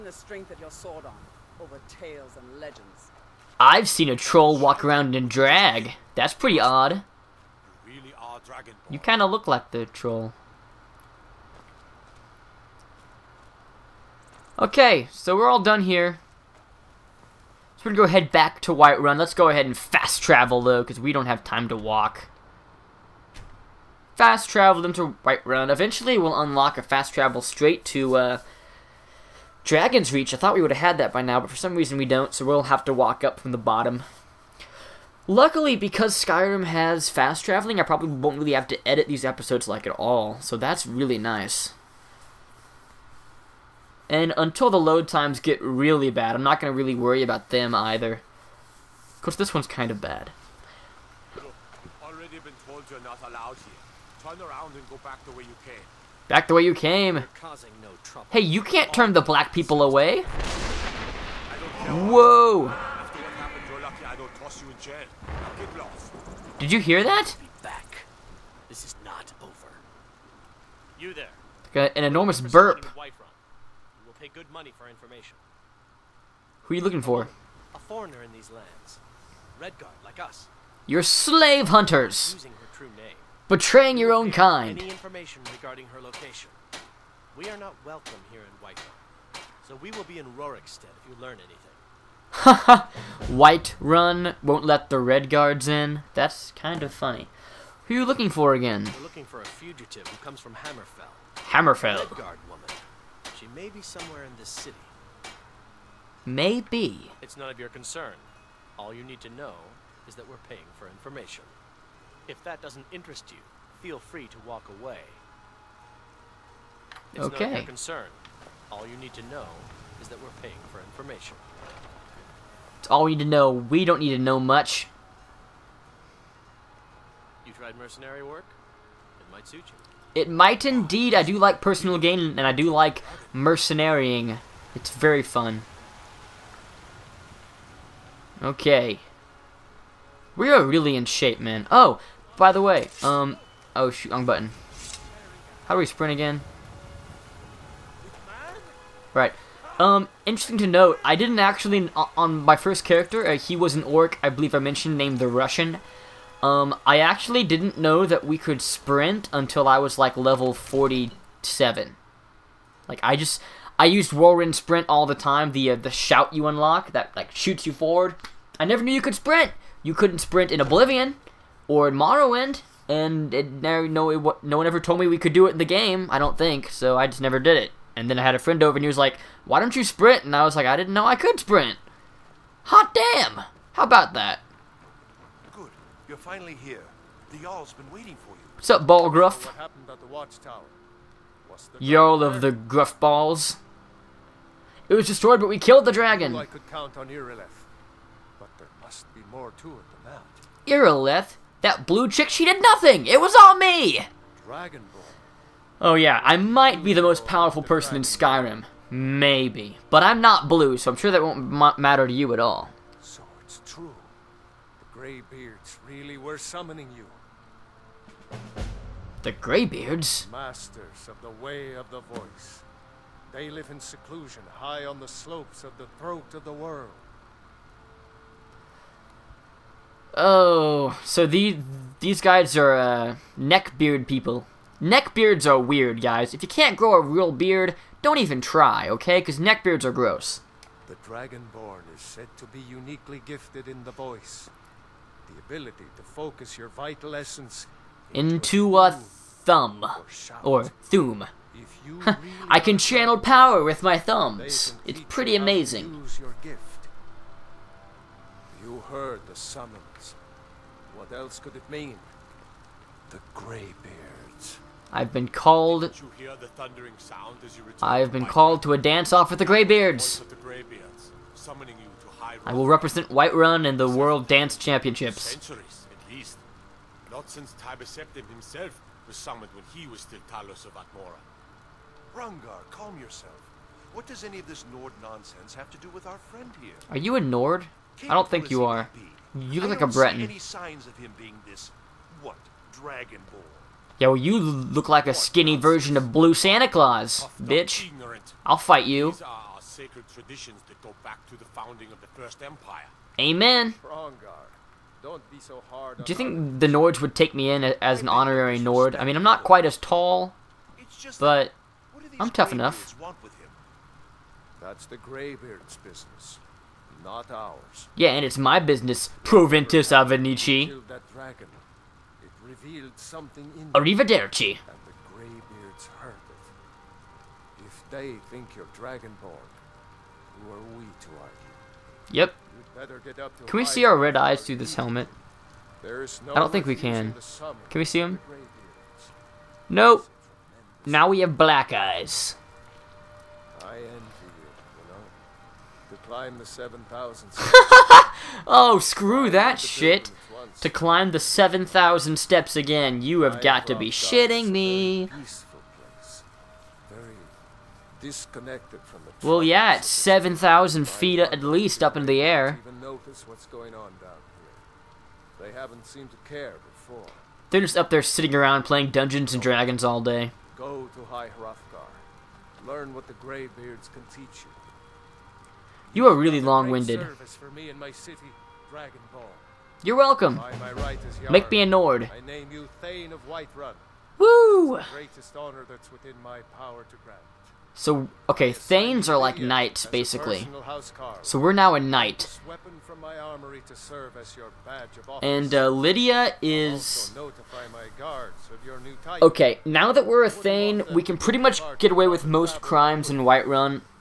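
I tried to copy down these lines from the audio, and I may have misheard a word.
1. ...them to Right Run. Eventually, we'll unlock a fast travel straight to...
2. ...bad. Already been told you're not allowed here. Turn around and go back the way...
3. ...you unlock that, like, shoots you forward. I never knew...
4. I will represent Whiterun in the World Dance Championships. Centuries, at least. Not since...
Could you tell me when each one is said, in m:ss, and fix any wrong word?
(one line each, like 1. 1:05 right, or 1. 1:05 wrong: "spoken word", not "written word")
1. 0:24 right
2. 0:49 right
3. 2:46 right
4. 4:32 right.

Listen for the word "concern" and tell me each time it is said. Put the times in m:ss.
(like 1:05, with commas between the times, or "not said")
1:47, 1:57.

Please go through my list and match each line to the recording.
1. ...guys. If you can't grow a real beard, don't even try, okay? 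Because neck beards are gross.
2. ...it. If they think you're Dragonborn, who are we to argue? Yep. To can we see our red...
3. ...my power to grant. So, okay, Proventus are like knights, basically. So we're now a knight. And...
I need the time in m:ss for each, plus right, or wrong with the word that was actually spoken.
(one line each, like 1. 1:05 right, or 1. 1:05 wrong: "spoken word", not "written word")
1. 3:56 right
2. 5:26 right
3. 6:26 wrong: "Thanes", not "Proventus".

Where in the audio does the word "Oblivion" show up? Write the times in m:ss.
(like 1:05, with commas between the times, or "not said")
2:50.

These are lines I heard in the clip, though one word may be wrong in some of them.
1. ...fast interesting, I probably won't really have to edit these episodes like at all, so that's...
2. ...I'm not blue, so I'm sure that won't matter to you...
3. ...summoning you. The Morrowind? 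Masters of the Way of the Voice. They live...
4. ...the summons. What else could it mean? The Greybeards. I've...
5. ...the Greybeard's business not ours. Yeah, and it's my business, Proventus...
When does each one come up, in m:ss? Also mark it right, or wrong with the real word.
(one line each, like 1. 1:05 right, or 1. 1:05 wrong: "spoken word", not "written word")
1. 0:37 wrong: "traveling", not "interesting"
2. 3:30 right
3. 3:36 wrong: "Greybeards", not "Morrowind"
4. 4:19 right
5. 5:14 right.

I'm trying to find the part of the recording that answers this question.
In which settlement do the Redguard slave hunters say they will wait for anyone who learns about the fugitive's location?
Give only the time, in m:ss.
1:30.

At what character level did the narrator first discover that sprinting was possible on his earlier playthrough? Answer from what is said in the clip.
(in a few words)
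47.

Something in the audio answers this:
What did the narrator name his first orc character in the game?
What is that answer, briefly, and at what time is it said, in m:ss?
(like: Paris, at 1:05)
the Russian, at 2:35.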